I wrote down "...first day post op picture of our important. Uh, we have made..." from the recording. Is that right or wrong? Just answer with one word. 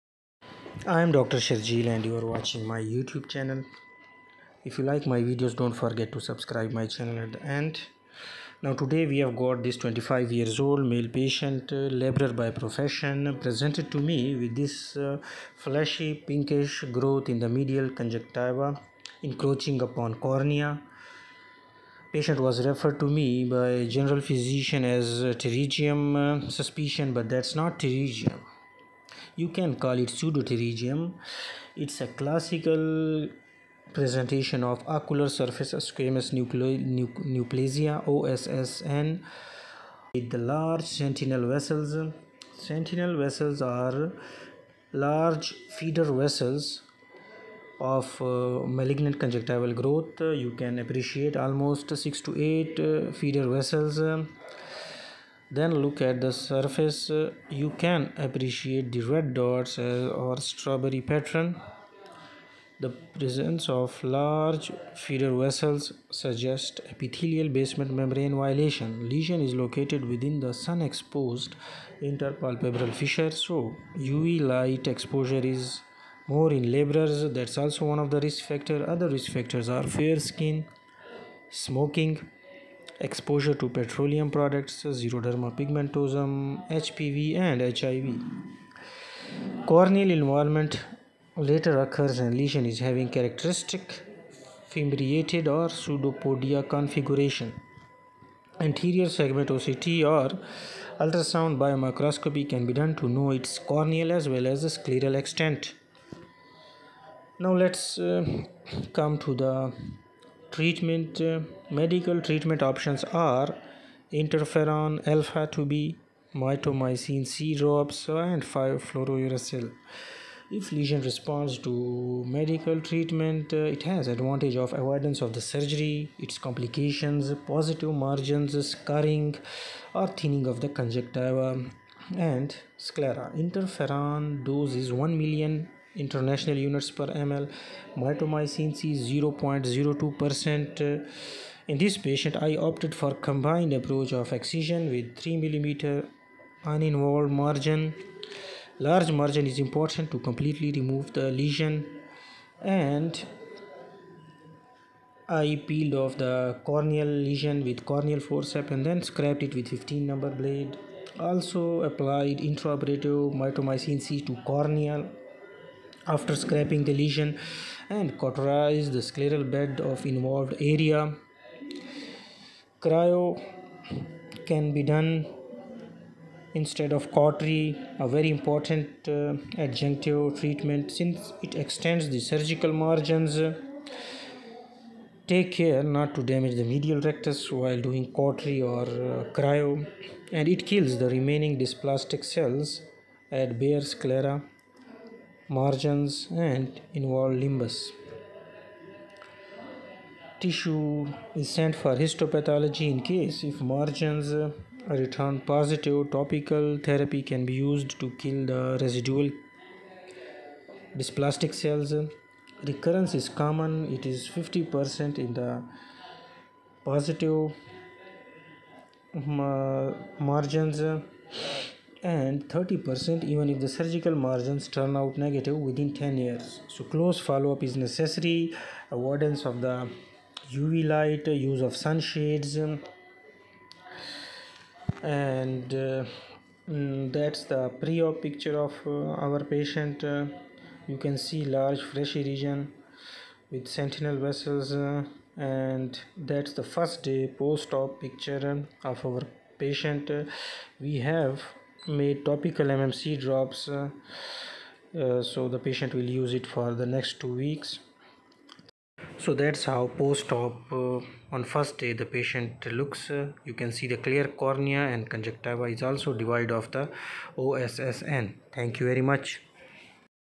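wrong.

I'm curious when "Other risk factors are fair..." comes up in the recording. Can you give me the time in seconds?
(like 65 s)
78 s.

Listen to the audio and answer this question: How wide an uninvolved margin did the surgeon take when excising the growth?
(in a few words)
3 millimeter.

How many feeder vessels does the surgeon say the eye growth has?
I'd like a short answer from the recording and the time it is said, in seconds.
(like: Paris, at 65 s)
6 to 8, at 51 s.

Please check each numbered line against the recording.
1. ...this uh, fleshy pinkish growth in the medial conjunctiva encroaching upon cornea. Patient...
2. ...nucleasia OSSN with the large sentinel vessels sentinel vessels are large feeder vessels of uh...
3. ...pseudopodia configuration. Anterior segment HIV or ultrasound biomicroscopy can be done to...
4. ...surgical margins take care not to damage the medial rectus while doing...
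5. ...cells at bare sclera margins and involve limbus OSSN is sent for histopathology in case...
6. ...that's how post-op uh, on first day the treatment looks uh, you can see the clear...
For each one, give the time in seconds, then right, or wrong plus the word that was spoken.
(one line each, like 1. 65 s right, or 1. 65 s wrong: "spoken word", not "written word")
1. 14 s right
2. 37 s right
3. 95 s wrong: "OCT", not "HIV"
4. 182 s right
5. 192 s wrong: "Tissue", not "OSSN"
6. 259 s wrong: "patient", not "treatment".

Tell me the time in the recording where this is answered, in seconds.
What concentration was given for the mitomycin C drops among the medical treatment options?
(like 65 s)
139 s.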